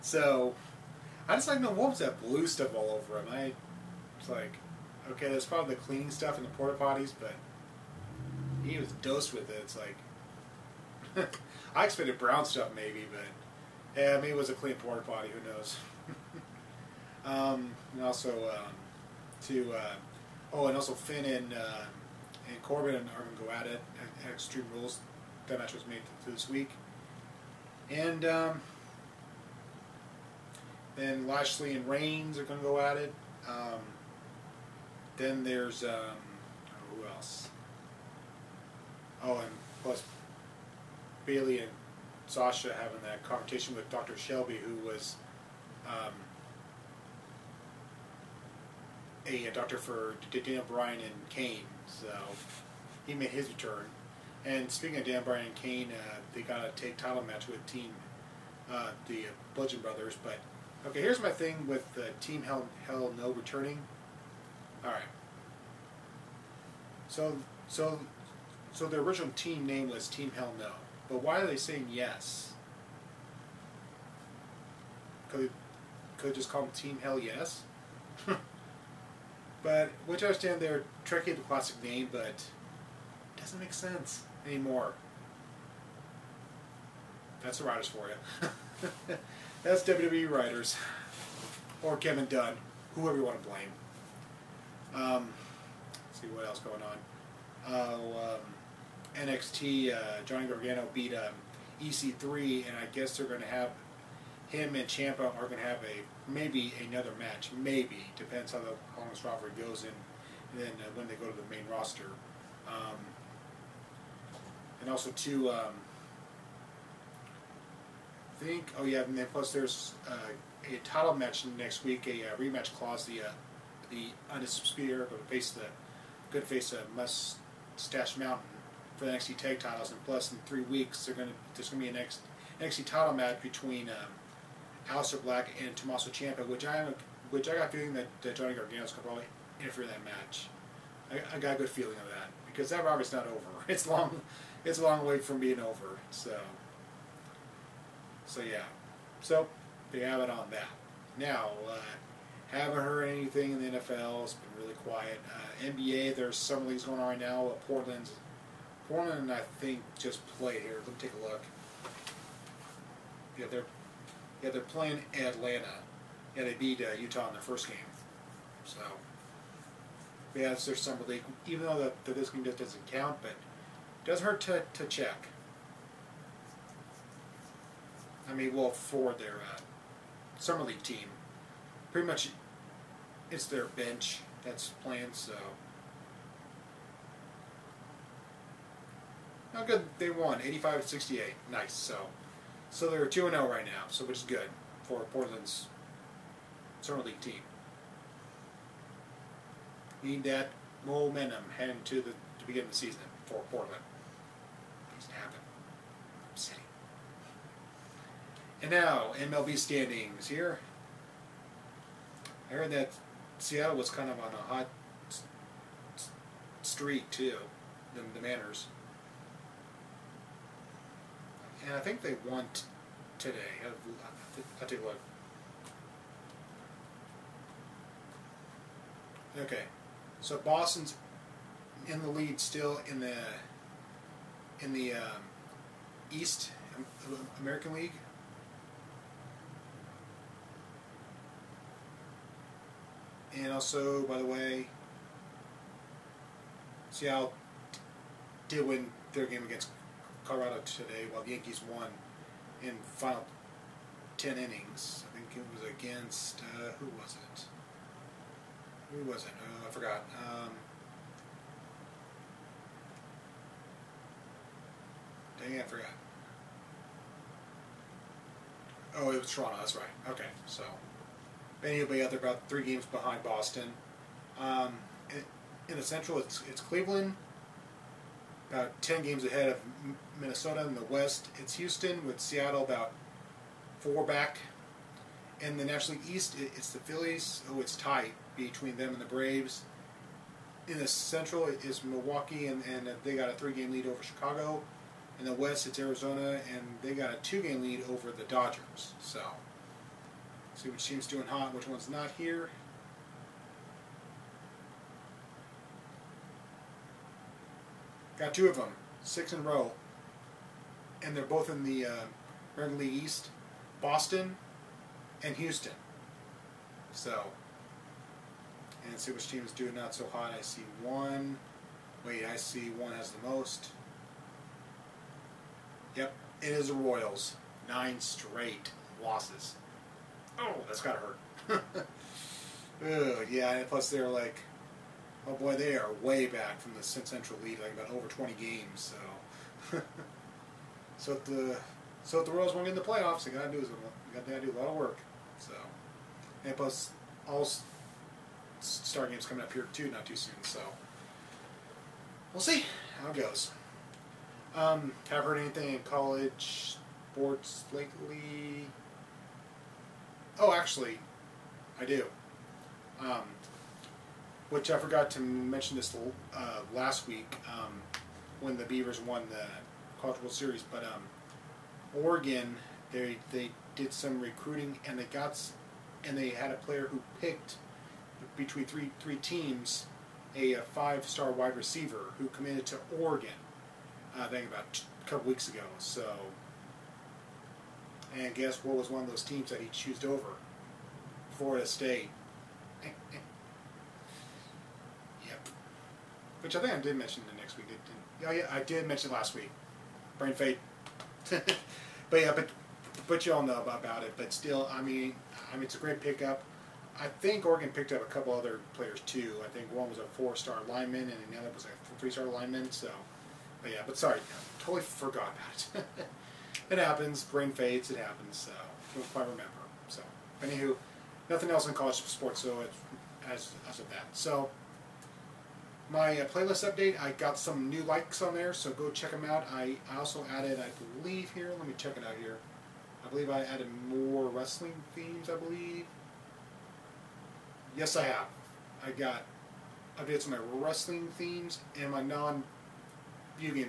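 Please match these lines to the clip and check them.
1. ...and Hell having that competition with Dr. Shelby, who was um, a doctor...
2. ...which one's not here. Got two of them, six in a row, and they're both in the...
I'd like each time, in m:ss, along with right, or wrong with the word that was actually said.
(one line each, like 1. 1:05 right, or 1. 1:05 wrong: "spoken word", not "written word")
1. 0:41 wrong: "Sasha", not "Hell"
2. 5:01 right.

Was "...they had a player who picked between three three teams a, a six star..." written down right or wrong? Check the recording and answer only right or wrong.
wrong.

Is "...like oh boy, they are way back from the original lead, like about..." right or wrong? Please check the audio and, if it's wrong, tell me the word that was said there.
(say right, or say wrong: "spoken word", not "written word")
wrong: "central", not "original".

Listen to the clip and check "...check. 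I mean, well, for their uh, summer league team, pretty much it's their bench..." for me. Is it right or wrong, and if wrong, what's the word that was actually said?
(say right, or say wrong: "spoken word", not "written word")
right.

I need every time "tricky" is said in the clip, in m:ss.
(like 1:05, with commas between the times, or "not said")
1:21.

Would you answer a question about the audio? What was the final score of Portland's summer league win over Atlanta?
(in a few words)
85-68.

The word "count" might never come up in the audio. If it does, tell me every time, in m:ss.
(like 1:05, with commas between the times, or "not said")
2:52.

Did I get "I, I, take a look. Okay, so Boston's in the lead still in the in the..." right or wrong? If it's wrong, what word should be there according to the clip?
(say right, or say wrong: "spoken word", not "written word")
right.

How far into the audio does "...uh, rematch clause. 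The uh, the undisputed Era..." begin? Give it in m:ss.
2:02.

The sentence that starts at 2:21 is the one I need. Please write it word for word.
I, I, got a good feeling of that because that rivalry's not over.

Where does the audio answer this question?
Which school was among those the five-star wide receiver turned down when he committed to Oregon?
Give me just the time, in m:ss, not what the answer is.
6:31.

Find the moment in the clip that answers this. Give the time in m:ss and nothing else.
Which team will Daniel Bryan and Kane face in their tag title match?
0:59.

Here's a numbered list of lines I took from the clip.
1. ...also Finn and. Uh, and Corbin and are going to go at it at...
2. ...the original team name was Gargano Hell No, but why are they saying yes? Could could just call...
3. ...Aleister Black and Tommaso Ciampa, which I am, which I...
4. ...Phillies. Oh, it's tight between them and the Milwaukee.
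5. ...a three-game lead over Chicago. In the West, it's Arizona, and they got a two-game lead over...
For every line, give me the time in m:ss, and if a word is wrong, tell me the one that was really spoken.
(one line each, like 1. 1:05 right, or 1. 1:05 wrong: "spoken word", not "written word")
1. 0:20 right
2. 1:08 wrong: "Team", not "Gargano"
3. 2:14 right
4. 4:46 wrong: "Braves", not "Milwaukee"
5. 4:53 right.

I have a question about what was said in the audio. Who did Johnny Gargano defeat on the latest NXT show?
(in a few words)
EC3.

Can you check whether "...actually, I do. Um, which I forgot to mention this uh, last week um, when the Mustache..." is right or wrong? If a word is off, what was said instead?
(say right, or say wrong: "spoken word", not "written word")
wrong: "Beavers", not "Mustache".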